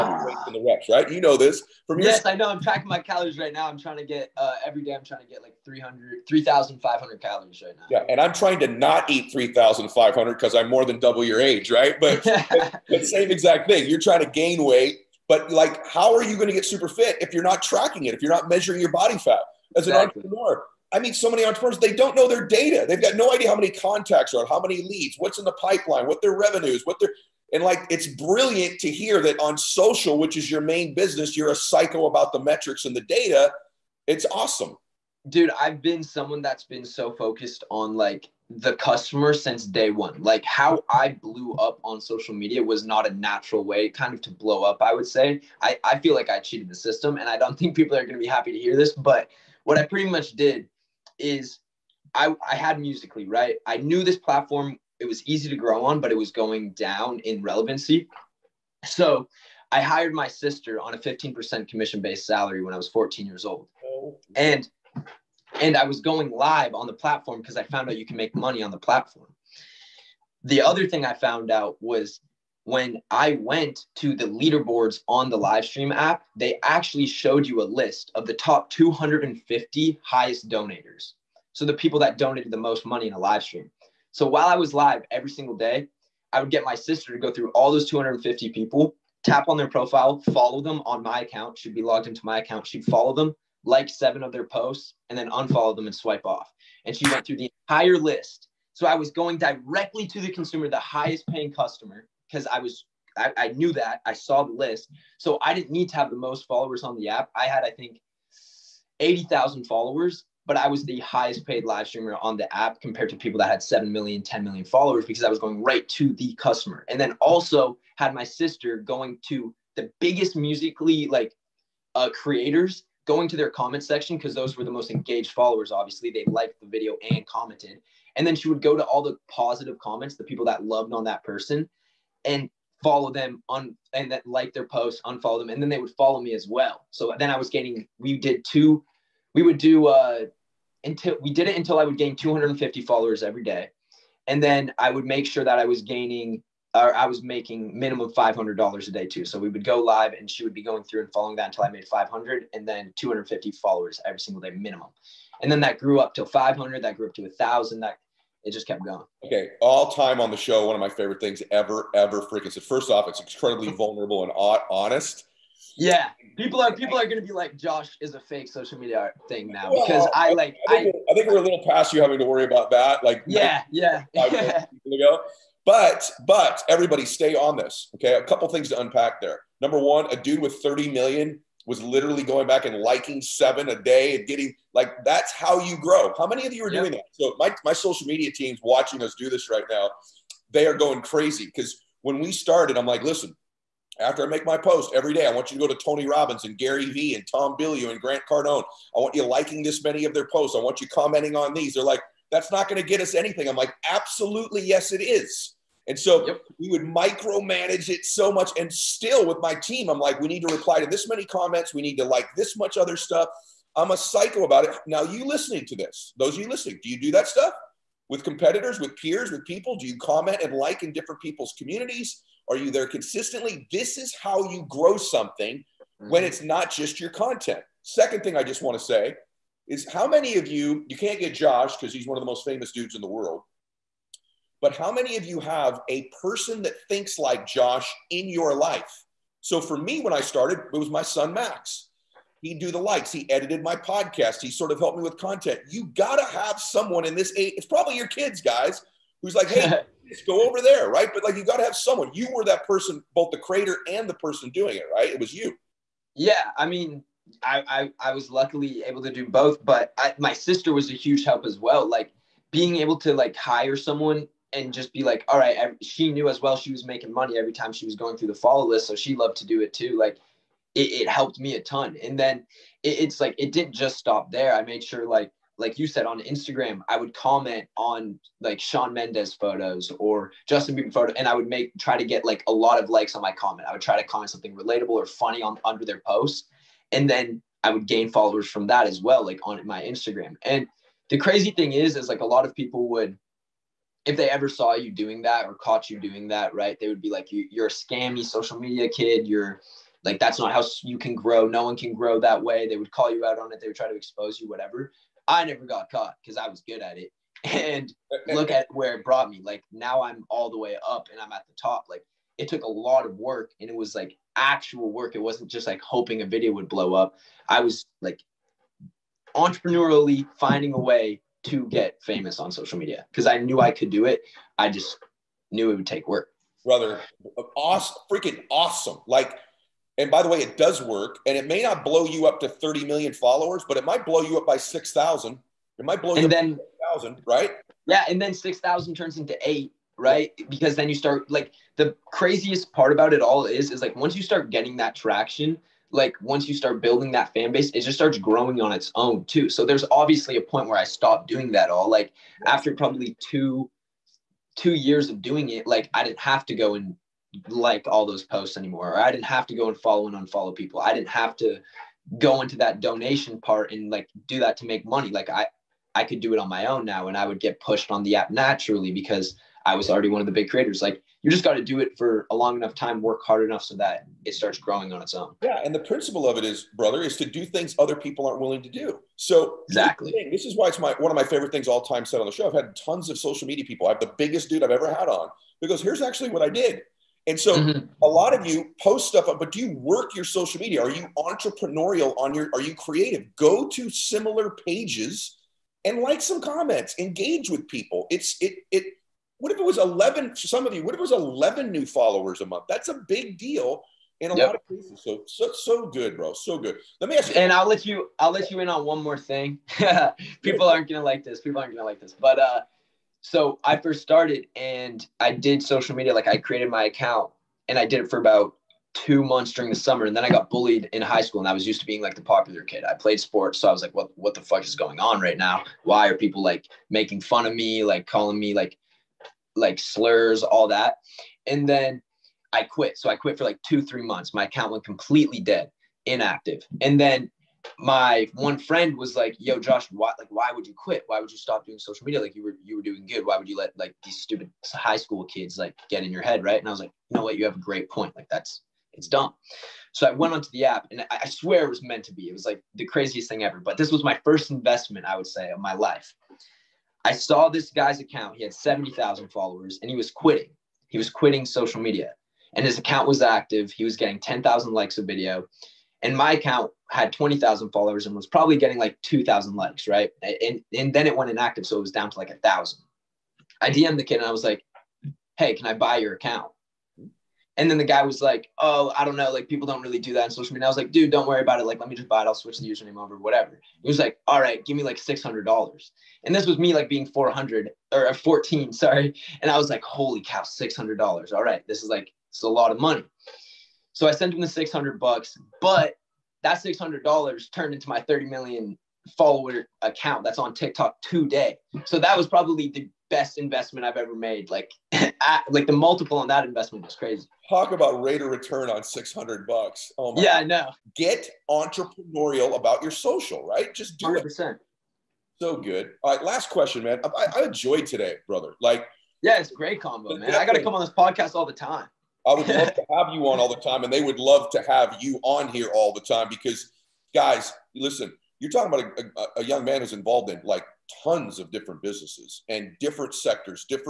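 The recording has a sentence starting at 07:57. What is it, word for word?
And then the guy was like, "Oh, I don't know.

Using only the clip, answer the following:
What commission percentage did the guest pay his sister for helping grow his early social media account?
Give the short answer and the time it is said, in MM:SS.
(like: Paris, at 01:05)
15%, at 01:00.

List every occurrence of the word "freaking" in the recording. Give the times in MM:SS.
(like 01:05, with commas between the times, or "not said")
02:42, 05:28.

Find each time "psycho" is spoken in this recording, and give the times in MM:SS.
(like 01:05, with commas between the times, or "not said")
00:31, 03:33.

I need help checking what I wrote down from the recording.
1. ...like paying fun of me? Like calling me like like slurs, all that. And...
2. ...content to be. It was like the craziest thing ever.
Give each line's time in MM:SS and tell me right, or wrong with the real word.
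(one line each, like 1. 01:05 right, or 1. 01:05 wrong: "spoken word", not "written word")
1. 07:06 wrong: "making", not "paying"
2. 07:31 wrong: "meant", not "content".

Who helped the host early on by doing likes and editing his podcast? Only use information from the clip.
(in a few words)
Max.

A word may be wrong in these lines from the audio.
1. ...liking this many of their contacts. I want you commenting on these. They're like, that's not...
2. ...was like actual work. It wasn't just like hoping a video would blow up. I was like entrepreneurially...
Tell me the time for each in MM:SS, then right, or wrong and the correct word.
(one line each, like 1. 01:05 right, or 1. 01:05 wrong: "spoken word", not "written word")
1. 03:19 wrong: "posts", not "contacts"
2. 05:13 right.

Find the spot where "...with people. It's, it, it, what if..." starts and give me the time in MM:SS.
06:37.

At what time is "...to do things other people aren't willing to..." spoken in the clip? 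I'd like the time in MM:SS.
06:17.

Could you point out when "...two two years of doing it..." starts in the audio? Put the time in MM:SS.
05:53.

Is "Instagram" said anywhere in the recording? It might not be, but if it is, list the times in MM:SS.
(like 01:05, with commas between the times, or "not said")
04:36, 04:49.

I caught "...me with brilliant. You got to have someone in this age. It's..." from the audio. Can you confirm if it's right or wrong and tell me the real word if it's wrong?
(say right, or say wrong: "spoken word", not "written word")
wrong: "content", not "brilliant".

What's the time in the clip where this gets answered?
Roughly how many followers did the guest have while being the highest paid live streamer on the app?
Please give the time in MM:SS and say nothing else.
01:48.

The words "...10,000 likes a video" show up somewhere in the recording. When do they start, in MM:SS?
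07:44.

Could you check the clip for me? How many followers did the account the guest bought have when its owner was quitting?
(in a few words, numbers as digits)
70,000.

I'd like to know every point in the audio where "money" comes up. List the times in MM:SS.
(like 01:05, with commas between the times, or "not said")
01:08, 01:22, 04:27, 06:04, 08:12.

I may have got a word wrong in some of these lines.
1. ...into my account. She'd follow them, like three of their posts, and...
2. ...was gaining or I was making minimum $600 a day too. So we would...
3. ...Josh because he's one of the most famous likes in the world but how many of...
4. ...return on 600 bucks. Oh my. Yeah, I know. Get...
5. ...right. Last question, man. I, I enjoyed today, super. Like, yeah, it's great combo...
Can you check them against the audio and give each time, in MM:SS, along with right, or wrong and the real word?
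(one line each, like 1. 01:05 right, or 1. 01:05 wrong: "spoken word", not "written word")
1. 01:32 wrong: "seven", not "three"
2. 02:25 wrong: "500", not "600"
3. 03:51 wrong: "dudes", not "likes"
4. 08:28 right
5. 08:36 wrong: "brother", not "super".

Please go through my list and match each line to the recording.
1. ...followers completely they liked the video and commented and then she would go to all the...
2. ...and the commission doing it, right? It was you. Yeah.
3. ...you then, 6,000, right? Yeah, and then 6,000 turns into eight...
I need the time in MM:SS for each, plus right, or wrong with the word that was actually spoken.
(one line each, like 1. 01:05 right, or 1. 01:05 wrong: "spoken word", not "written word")
1. 02:05 wrong: "obviously", not "completely"
2. 04:13 wrong: "person", not "commission"
3. 05:36 right.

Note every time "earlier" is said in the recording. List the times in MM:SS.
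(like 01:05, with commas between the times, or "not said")
not said.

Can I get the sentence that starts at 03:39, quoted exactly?
Do you comment and like in different people's communities?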